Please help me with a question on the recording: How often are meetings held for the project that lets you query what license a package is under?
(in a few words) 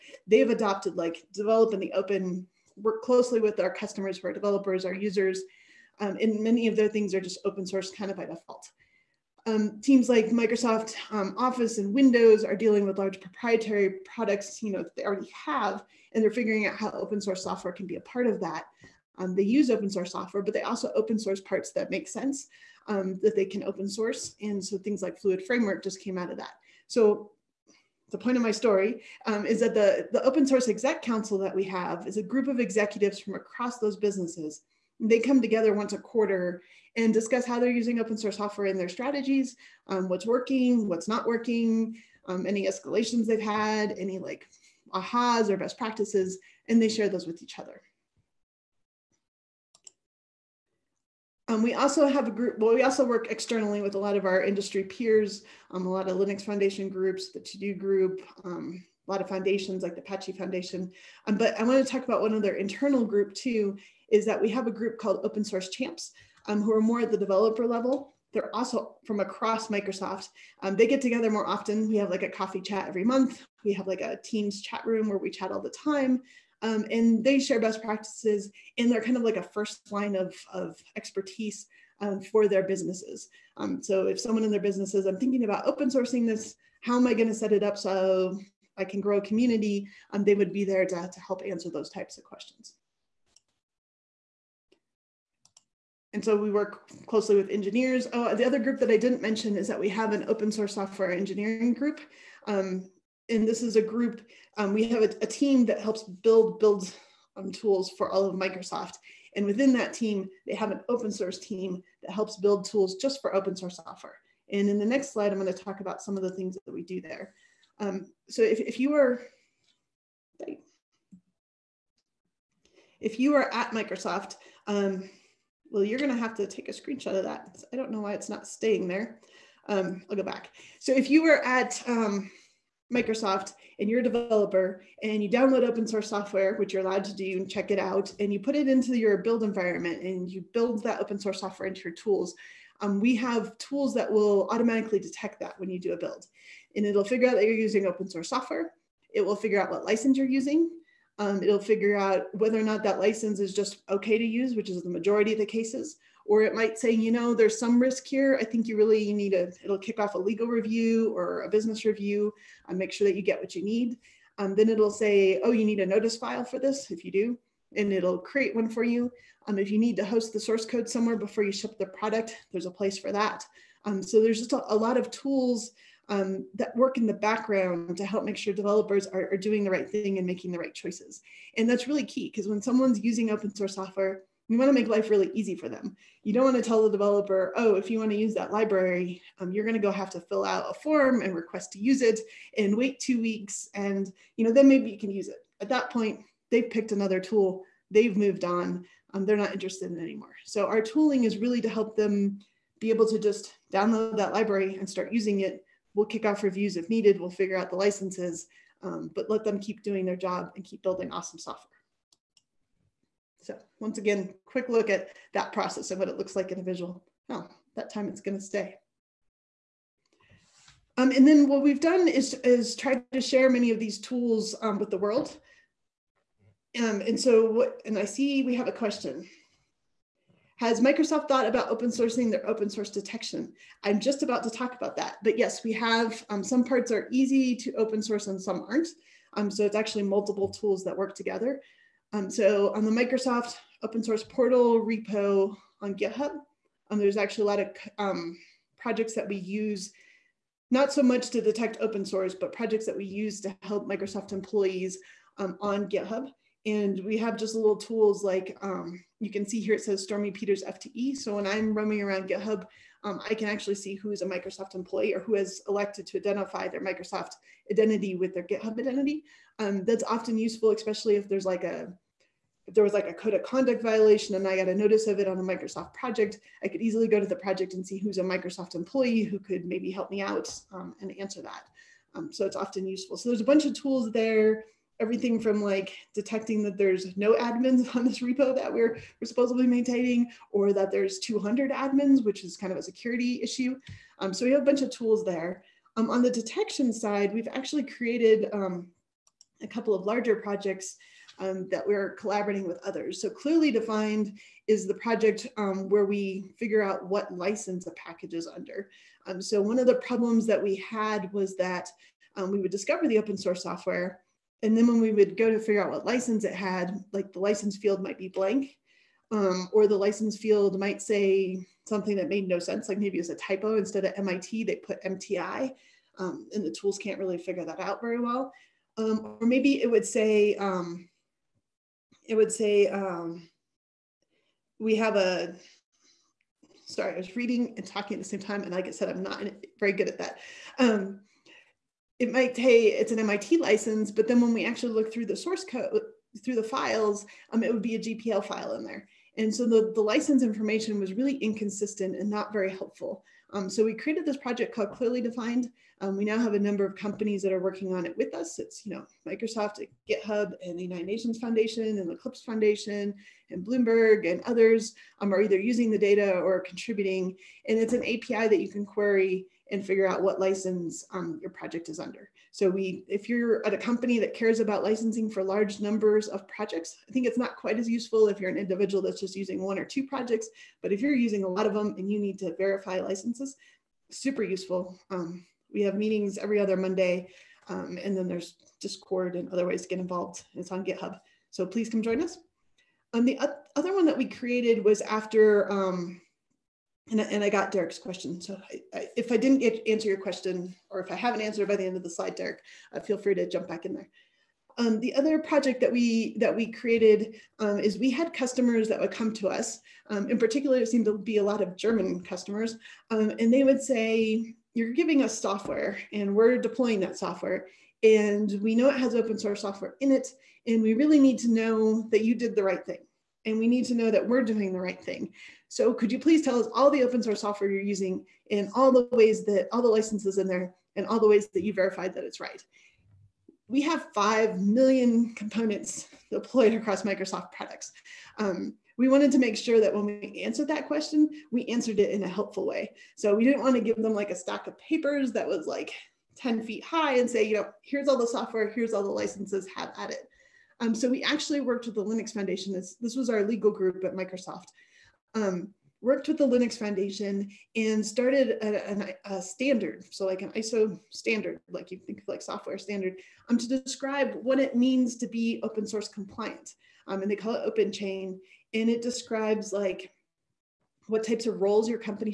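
Every other Monday.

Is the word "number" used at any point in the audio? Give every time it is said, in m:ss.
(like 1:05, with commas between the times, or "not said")
5:56, 6:15.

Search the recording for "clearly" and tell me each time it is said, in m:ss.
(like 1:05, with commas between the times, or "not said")
5:03, 5:54.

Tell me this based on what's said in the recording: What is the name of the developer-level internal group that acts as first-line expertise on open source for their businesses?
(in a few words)
Open Source Champs.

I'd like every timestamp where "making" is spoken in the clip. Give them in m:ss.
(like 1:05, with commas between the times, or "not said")
3:00.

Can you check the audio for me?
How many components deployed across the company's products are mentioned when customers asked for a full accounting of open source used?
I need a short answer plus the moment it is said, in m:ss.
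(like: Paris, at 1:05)
5 million, at 7:14.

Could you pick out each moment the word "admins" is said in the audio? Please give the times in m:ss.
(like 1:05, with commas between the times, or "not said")
4:47, 4:51.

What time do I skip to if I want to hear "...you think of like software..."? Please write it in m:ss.
7:41.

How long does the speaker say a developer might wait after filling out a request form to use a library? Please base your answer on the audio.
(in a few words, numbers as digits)
Two weeks.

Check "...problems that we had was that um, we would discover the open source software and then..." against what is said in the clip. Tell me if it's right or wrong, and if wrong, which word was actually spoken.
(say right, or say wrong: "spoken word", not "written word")
right.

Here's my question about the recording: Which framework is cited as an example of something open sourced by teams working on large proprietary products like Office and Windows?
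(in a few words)
Fluid Framework.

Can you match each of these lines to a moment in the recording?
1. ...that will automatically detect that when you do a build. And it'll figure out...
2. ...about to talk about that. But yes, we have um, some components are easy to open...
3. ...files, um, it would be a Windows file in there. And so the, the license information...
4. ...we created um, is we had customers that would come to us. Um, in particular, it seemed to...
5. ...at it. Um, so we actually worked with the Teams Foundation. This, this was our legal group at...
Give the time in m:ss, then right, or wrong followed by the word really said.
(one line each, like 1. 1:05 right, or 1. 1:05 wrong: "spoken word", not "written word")
1. 2:23 right
2. 3:54 wrong: "parts", not "components"
3. 5:46 wrong: "GPL", not "Windows"
4. 6:46 right
5. 7:29 wrong: "Linux", not "Teams".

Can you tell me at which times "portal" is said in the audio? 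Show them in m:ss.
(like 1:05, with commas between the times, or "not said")
4:04.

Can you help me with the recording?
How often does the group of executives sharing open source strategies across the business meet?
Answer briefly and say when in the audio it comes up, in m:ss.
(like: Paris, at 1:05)
Once a quarter, at 0:35.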